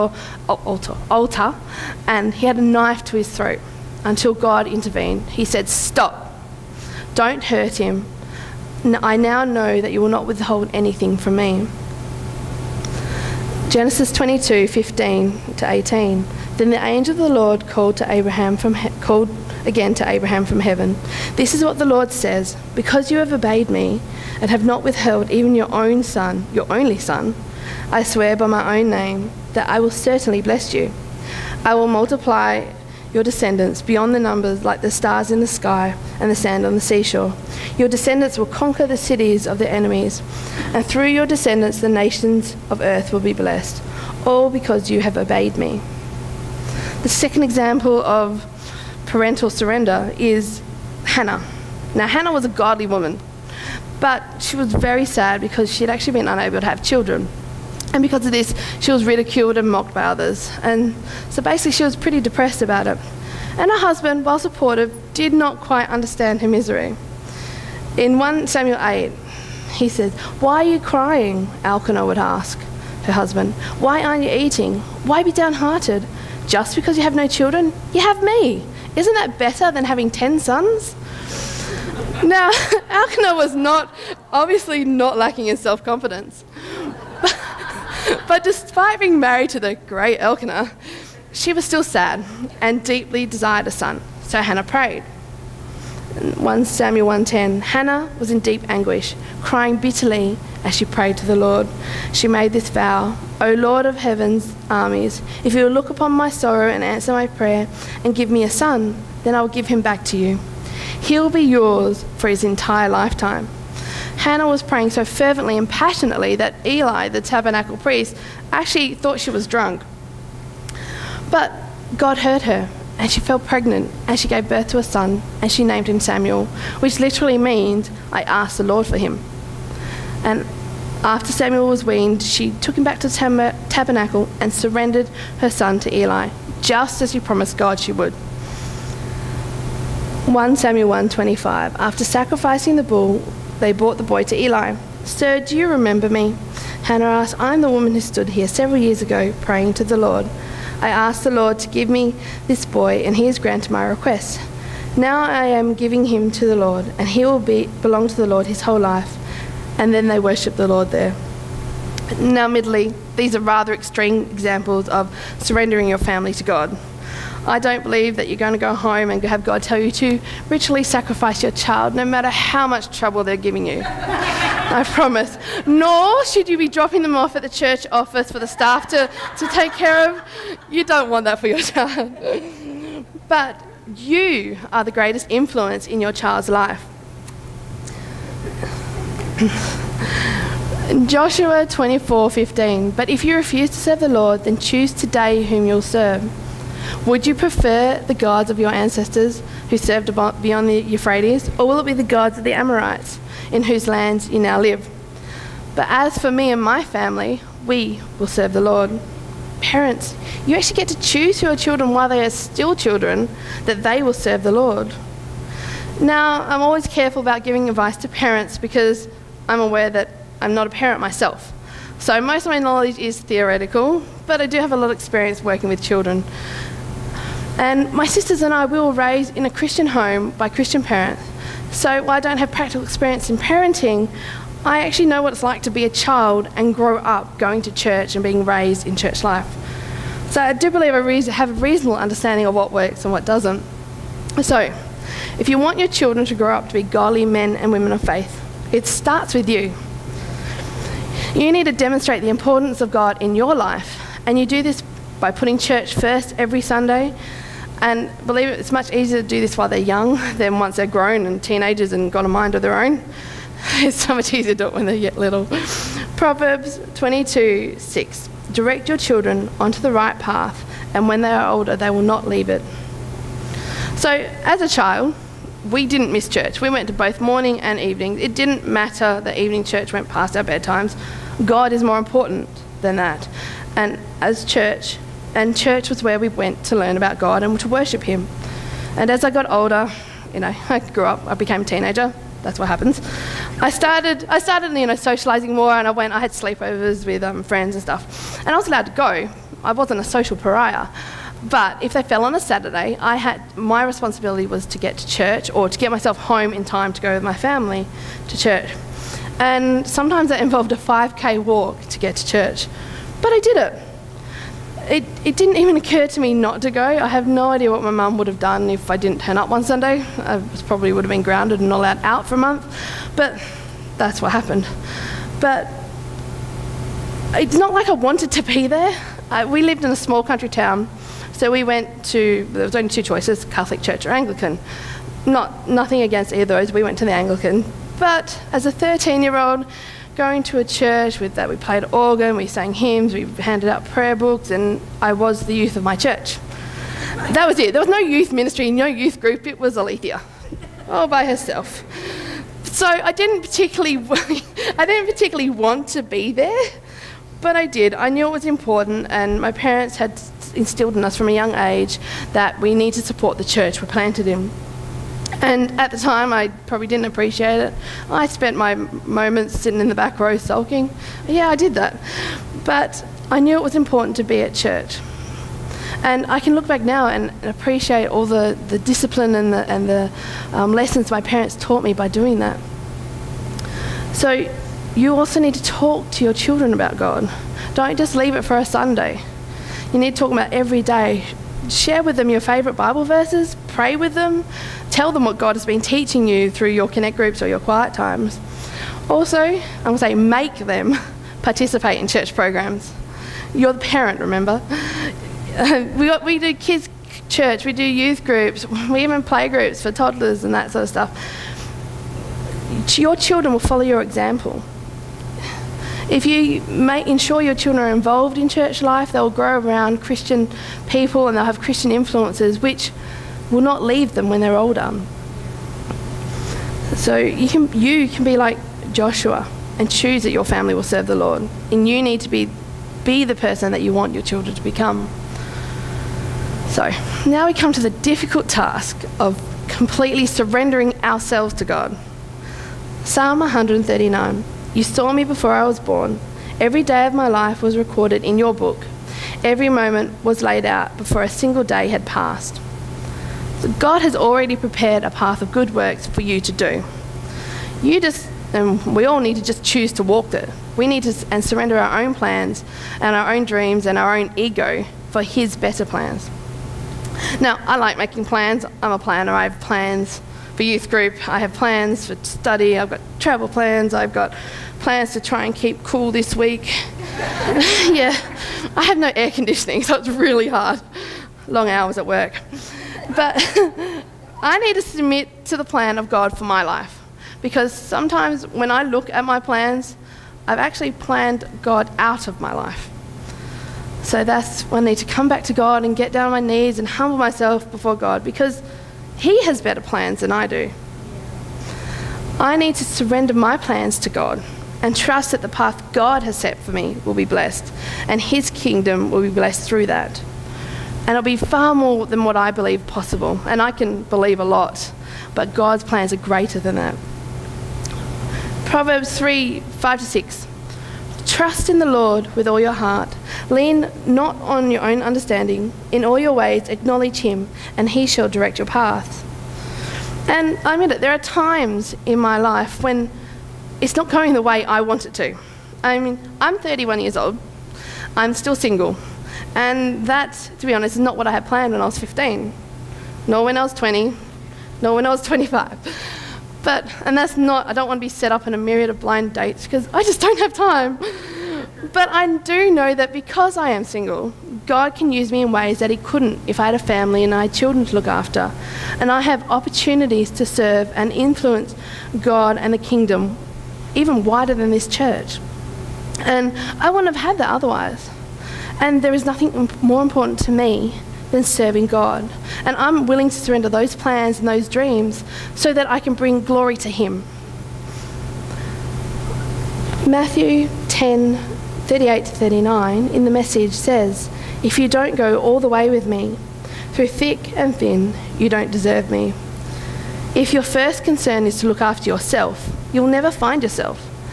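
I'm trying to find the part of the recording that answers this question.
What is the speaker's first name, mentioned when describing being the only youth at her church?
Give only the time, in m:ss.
5:49.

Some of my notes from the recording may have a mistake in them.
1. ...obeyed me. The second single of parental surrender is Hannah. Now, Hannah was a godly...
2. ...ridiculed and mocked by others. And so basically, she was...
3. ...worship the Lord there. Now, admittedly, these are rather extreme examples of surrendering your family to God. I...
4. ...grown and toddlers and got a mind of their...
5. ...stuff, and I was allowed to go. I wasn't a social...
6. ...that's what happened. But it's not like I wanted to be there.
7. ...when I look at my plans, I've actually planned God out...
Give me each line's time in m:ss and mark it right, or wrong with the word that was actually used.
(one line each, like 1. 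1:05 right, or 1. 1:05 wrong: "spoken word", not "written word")
1. 0:45 wrong: "example", not "single"
2. 0:59 right
3. 2:40 right
4. 4:20 wrong: "teenagers", not "toddlers"
5. 4:57 right
6. 5:23 right
7. 8:08 right.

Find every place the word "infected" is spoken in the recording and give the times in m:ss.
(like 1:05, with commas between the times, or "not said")
not said.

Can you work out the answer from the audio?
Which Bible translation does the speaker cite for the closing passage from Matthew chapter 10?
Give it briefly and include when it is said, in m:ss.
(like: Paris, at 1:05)
The Message, at 9:43.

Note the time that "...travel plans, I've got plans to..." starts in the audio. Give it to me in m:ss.
7:53.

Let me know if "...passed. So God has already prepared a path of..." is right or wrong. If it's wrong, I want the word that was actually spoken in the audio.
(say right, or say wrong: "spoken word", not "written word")
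right.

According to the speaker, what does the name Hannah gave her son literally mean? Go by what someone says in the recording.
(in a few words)
I asked the Lord for him.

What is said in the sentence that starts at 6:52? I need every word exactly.
Your children will follow your example.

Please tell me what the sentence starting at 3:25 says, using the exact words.
But as for me and my family, we will serve the Lord.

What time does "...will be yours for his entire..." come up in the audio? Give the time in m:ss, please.
1:51.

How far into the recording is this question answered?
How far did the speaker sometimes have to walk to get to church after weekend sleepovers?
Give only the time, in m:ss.
5:10.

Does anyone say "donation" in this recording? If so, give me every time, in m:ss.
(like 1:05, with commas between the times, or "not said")
not said.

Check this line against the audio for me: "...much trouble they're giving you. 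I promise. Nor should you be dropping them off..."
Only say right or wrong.
right.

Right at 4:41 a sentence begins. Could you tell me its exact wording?
God is more important than that.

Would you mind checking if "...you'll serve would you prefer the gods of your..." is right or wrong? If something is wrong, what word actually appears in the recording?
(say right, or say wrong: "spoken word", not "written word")
right.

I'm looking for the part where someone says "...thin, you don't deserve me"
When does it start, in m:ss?
9:47.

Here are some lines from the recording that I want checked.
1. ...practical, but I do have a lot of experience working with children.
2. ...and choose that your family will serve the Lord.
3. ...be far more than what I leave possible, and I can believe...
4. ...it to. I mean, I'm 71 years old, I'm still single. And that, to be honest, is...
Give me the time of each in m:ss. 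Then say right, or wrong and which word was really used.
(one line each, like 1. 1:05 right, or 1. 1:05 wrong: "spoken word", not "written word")
1. 3:43 wrong: "theoretical", not "practical"
2. 7:09 right
3. 8:31 wrong: "believe", not "leave"
4. 8:55 wrong: "31", not "71".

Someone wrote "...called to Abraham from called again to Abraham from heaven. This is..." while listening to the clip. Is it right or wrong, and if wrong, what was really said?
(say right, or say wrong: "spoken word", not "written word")
right.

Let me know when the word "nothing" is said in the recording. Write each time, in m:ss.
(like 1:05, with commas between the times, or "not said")
5:35, 9:29.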